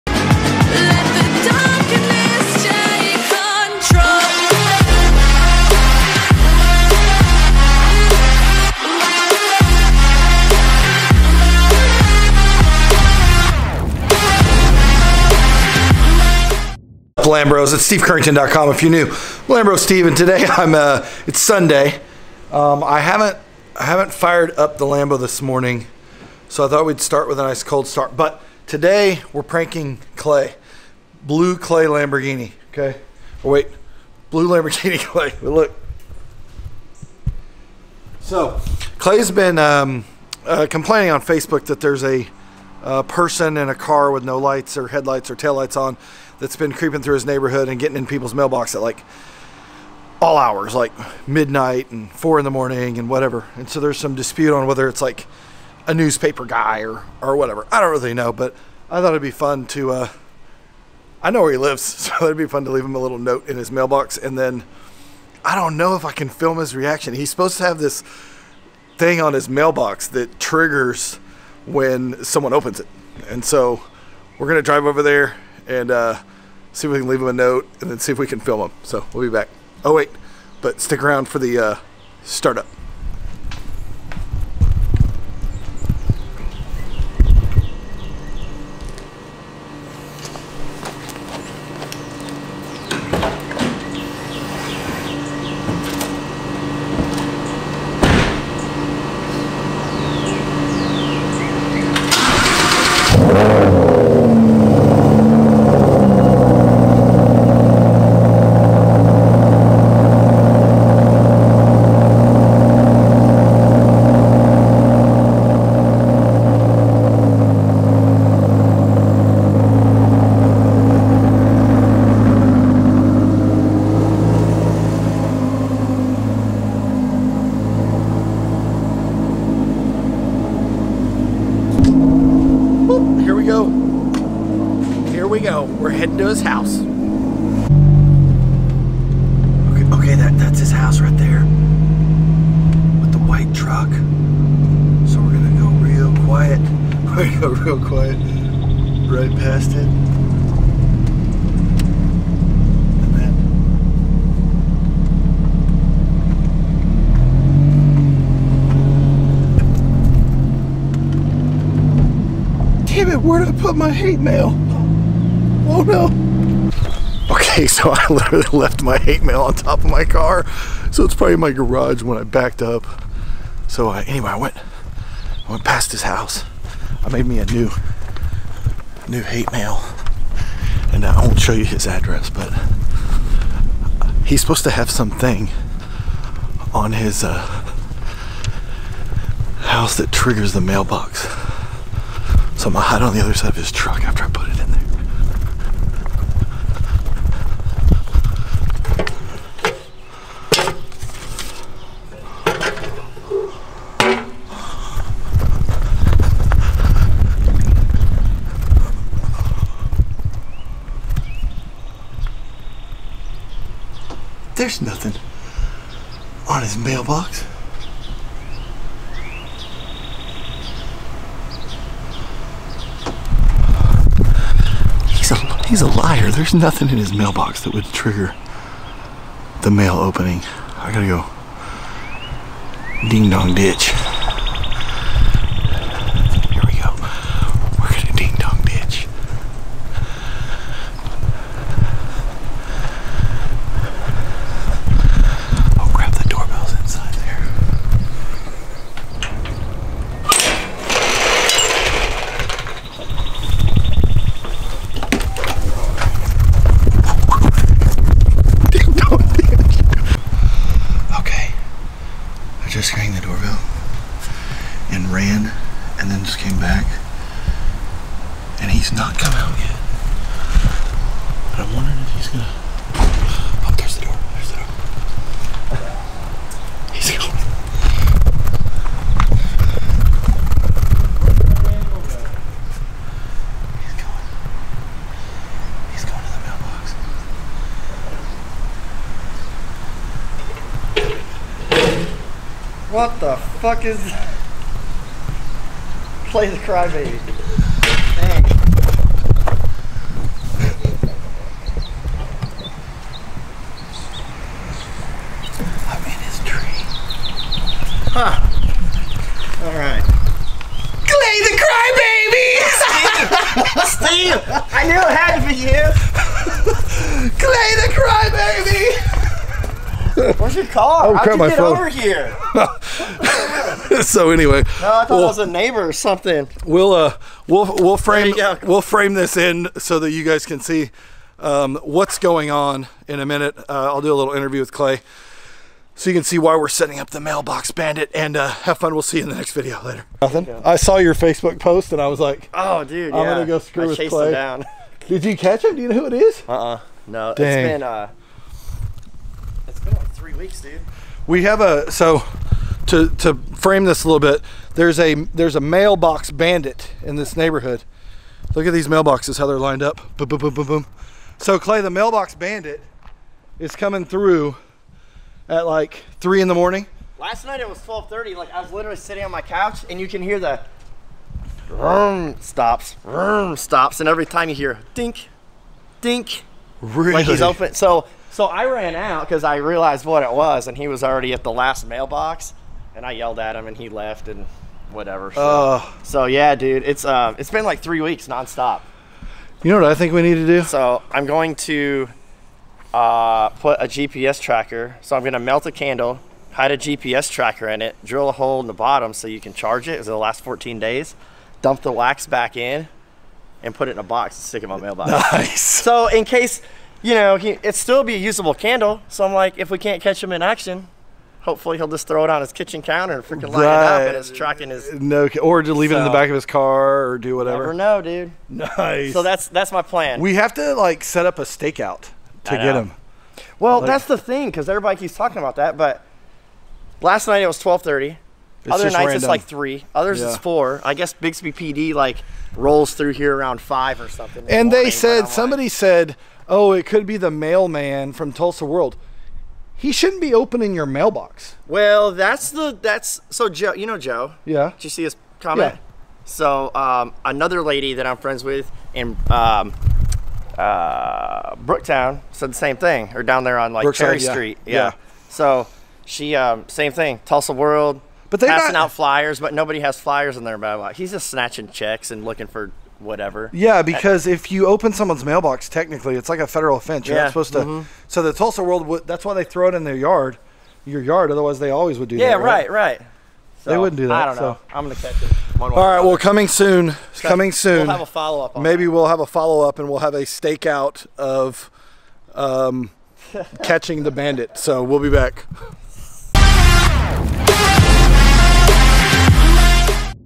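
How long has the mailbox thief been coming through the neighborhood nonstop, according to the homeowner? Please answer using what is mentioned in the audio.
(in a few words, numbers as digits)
3 weeks.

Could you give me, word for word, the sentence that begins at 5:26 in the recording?
We'll uh, we'll we'll frame we'll frame this in so that you guys can see um, what's going on in a minute.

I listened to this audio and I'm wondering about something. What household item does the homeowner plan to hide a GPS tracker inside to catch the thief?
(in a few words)
A candle.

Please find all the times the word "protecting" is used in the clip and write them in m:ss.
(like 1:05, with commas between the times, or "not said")
not said.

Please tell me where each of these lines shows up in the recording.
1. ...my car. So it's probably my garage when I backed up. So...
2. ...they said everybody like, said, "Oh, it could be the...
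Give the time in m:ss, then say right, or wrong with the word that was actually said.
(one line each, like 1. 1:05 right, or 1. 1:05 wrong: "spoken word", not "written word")
1. 2:49 right
2. 7:14 wrong: "somebody", not "everybody".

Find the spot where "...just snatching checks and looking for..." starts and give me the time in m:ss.
7:41.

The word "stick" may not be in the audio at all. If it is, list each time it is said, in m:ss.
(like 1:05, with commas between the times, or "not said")
1:20, 6:44.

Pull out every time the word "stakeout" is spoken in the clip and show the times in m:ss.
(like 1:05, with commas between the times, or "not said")
7:01, 8:00.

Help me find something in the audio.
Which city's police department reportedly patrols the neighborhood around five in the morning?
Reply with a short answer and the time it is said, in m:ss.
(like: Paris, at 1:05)
Bixby, at 7:11.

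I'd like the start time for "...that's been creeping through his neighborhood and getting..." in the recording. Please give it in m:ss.
0:46.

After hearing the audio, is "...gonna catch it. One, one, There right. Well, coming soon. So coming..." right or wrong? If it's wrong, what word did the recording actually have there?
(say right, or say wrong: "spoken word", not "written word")
wrong: "All", not "There".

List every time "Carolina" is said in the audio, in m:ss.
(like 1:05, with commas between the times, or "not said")
not said.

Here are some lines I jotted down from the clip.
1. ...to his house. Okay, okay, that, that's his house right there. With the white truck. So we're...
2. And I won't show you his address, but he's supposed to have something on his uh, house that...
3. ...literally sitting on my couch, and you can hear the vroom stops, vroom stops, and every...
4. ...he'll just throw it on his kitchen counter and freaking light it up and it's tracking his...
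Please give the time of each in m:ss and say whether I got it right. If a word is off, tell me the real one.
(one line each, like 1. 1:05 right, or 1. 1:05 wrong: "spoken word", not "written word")
1. 2:16 right
2. 3:00 right
3. 6:08 right
4. 6:51 right.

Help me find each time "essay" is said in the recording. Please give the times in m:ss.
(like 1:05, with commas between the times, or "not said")
not said.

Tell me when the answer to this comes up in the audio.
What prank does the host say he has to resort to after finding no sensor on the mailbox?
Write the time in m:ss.
3:53.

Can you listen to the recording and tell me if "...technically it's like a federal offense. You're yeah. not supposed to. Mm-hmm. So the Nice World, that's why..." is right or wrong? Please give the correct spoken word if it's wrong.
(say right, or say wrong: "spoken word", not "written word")
wrong: "Tulsa", not "Nice".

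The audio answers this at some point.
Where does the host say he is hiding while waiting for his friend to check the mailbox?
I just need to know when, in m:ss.
5:05.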